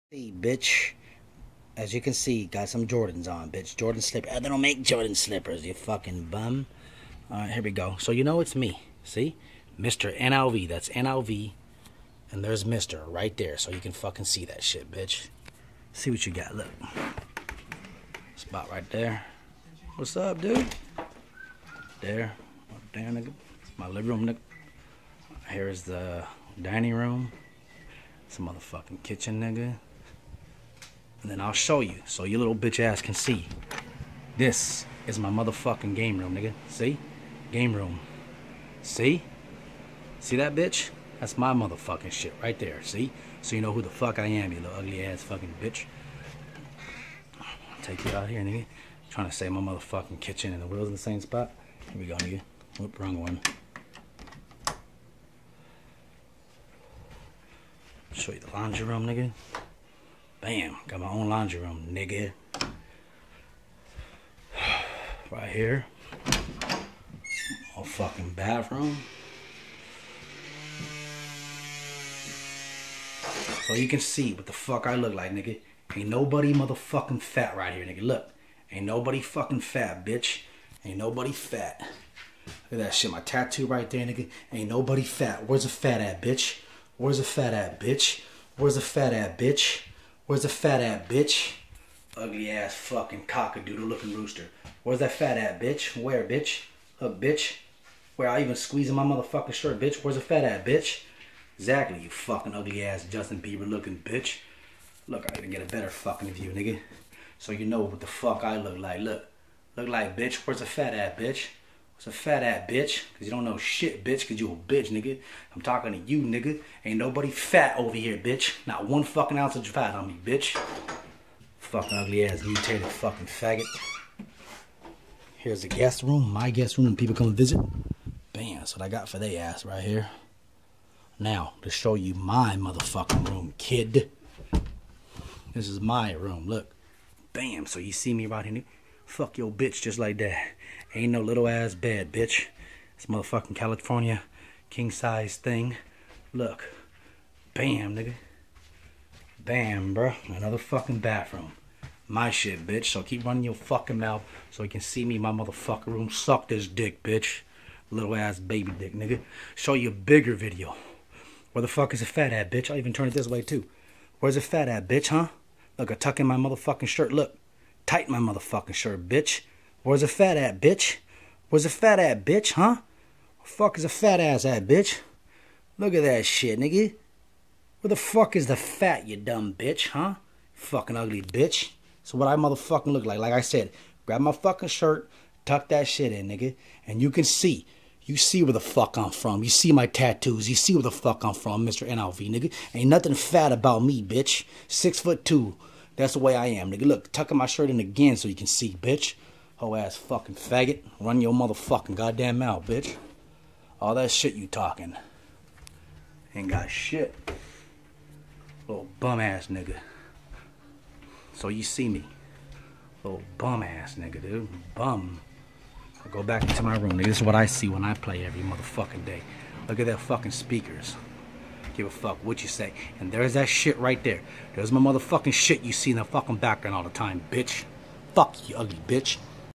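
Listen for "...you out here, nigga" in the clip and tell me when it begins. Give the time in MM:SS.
00:48.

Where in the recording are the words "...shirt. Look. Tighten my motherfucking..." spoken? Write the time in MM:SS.
02:46.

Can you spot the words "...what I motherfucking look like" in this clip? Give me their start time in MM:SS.
03:02.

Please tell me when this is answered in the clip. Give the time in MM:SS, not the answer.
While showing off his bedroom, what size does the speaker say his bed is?
02:23.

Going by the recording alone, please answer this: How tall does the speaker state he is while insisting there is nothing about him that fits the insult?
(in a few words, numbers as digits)
6 foot 2.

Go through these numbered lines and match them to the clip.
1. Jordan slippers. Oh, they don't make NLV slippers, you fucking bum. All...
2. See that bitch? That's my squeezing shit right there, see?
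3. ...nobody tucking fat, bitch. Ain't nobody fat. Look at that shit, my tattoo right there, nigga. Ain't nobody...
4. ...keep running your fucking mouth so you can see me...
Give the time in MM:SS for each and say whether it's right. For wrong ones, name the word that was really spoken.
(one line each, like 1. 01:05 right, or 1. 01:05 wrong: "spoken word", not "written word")
1. 00:03 wrong: "Jordan", not "NLV"
2. 00:40 wrong: "motherfucking", not "squeezing"
3. 01:18 wrong: "fucking", not "tucking"
4. 02:33 right.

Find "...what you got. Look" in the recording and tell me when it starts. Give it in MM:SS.
00:16.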